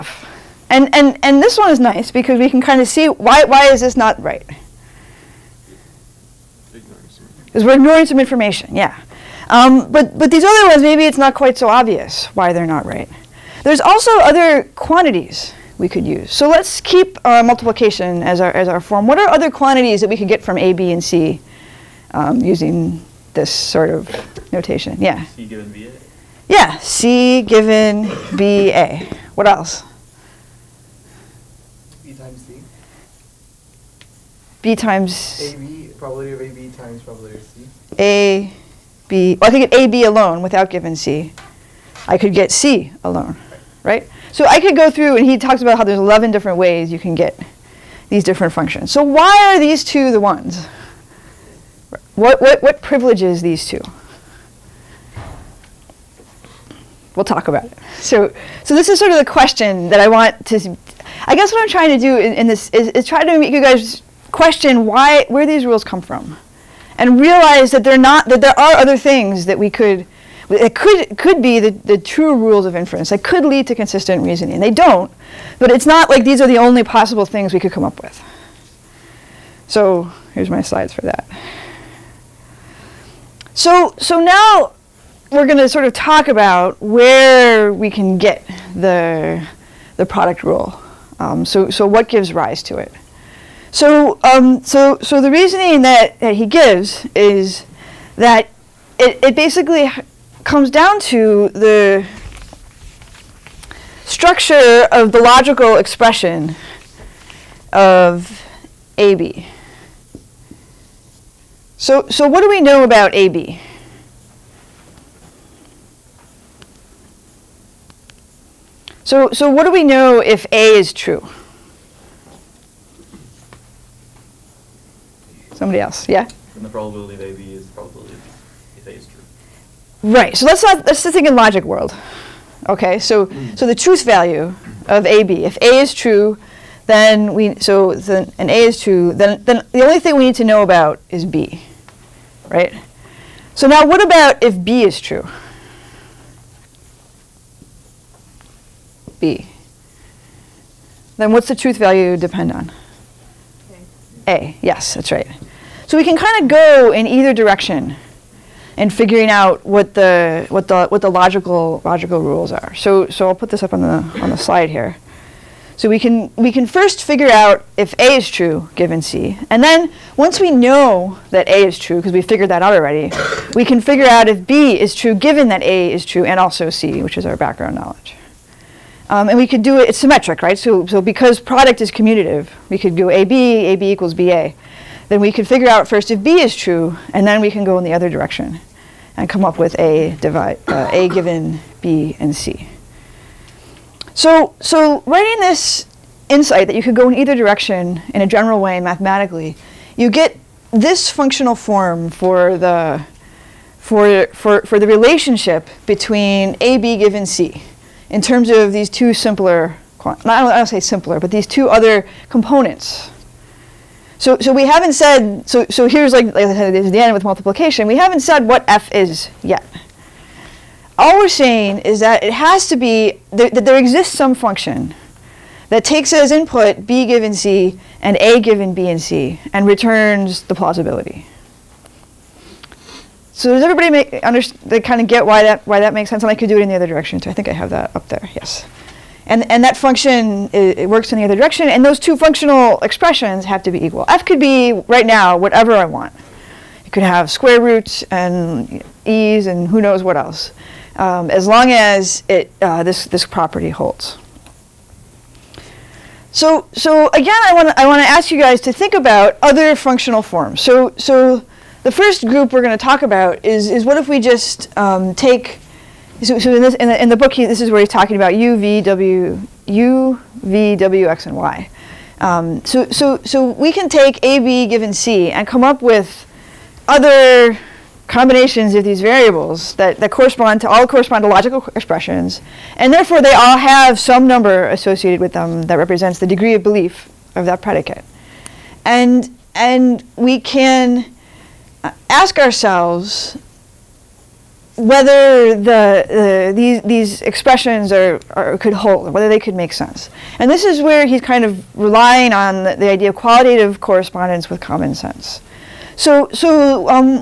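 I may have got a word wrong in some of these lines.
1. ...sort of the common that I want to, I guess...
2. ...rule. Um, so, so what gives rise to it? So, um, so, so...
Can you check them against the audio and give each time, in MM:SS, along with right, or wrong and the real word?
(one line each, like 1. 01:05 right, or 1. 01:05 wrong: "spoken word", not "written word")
1. 00:58 wrong: "question", not "common"
2. 01:30 right.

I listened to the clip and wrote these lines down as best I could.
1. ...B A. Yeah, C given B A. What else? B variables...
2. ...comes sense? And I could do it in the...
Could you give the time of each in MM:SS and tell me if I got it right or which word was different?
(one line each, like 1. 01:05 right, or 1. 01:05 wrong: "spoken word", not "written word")
1. 00:25 wrong: "times", not "variables"
2. 03:55 wrong: "makes", not "comes".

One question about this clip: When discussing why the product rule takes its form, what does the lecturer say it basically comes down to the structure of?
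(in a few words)
the logical expression of AB.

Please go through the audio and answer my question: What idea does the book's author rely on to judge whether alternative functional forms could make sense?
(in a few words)
qualitative correspondence with common sense.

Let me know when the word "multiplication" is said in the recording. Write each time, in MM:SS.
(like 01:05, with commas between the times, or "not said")
00:17, 03:37.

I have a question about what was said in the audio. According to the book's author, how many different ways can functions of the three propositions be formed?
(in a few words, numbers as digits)
11.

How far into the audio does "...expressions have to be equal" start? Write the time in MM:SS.
04:02.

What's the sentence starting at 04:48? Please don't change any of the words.
And, and we can uh, ask ourselves whether the, the, these, these expressions are, are, could hold, whether they could make sense.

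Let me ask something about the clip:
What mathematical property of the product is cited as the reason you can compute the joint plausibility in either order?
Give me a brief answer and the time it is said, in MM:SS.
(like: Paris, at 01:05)
commutative, at 03:01.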